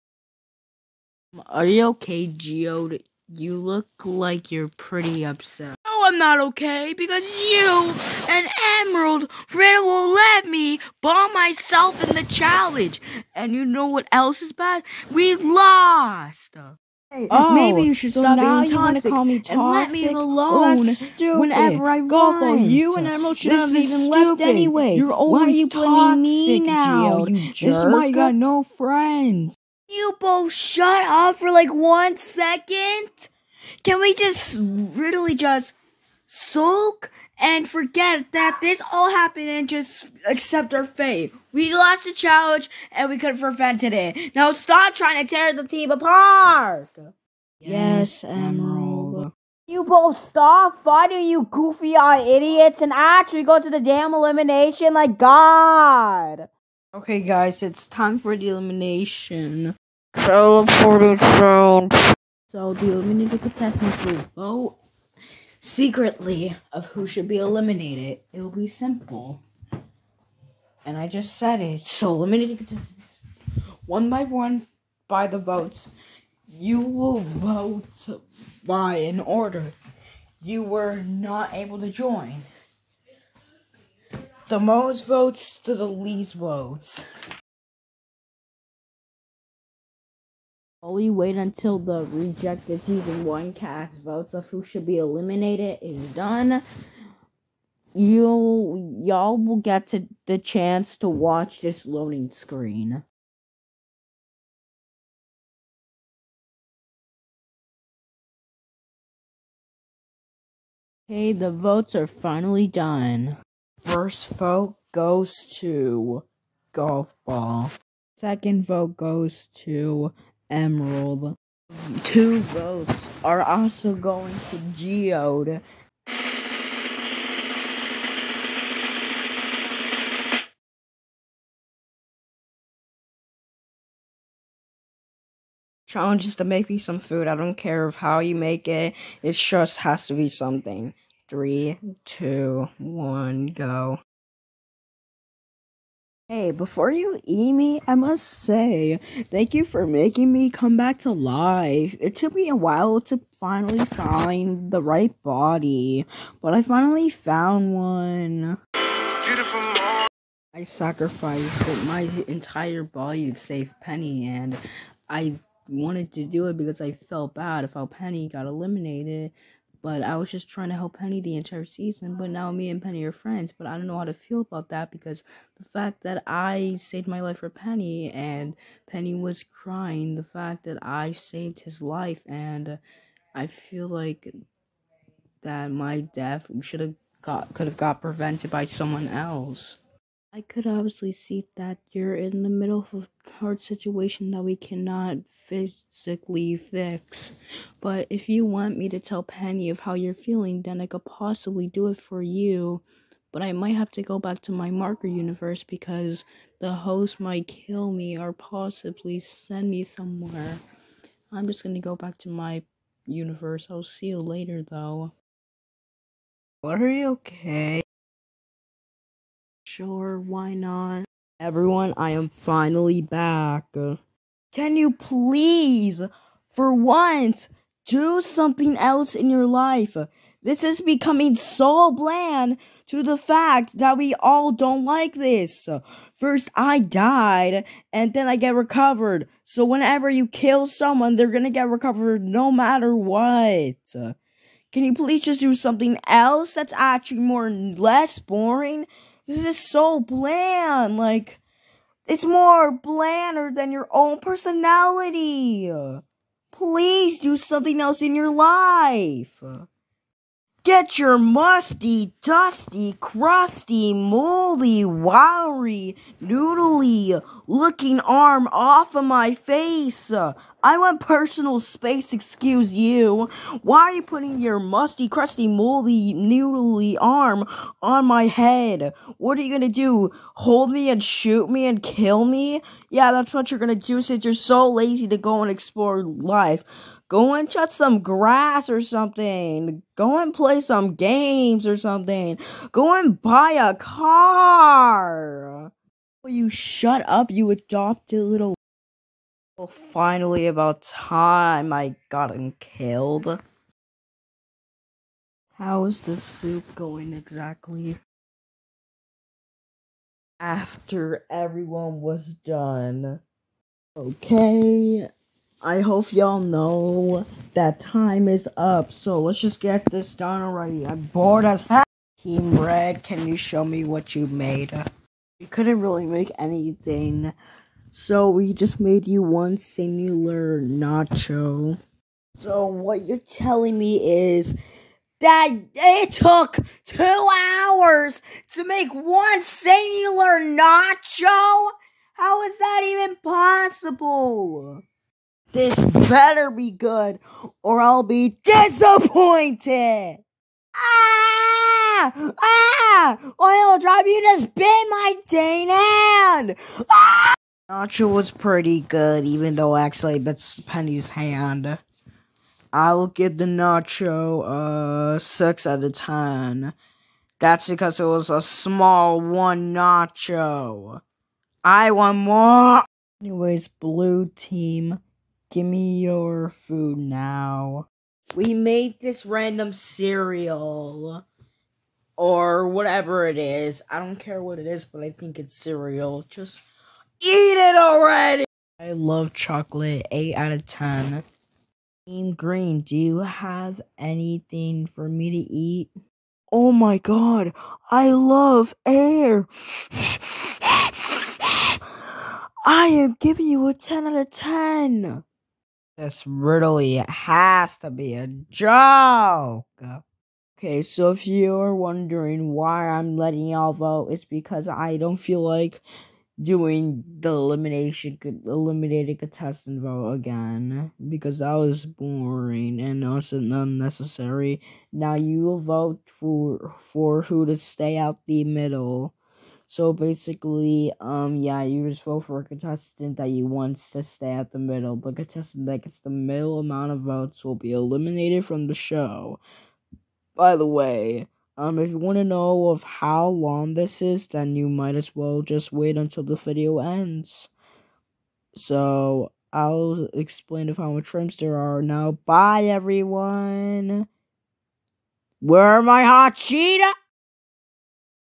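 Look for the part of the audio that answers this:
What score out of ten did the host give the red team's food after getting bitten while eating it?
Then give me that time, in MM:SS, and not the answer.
06:05.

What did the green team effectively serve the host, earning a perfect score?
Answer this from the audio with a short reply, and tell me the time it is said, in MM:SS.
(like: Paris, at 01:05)
Air, at 06:38.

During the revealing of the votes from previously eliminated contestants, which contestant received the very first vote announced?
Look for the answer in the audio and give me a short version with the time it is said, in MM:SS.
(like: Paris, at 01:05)
Golf ball, at 01:56.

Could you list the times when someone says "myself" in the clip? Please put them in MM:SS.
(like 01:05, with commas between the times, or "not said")
00:11.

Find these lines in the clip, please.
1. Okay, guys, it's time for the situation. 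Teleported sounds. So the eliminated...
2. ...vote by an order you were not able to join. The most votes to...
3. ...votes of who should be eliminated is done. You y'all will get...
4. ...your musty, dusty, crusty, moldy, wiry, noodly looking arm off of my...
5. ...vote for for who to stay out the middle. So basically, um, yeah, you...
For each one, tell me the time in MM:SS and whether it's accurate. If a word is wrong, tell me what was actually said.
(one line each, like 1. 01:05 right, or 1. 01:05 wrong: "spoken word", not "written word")
1. 00:56 wrong: "elimination", not "situation"
2. 01:17 right
3. 01:34 right
4. 04:20 right
5. 07:05 right.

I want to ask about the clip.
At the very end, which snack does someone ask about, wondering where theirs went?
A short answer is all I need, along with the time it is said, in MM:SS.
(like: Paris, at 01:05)
Hot cheetah, at 07:36.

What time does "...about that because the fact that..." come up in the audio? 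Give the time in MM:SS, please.
02:54.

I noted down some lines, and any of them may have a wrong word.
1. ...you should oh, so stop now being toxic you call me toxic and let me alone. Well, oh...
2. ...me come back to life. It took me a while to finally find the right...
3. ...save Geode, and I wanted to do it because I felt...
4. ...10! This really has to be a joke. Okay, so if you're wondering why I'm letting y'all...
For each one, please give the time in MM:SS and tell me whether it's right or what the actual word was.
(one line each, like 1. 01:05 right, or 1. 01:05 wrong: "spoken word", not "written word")
1. 00:17 right
2. 02:30 right
3. 02:43 wrong: "Penny", not "Geode"
4. 06:44 right.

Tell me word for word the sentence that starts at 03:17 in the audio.
But if you want me to tell Penny of how you're feeling, then I could possibly do it for you.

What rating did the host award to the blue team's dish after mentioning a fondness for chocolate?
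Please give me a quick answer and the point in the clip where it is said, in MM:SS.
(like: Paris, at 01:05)
8, at 06:30.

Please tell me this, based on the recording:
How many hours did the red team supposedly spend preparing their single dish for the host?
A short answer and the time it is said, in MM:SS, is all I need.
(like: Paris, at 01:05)
2, at 05:36.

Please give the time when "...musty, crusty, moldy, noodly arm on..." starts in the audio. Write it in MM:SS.
04:34.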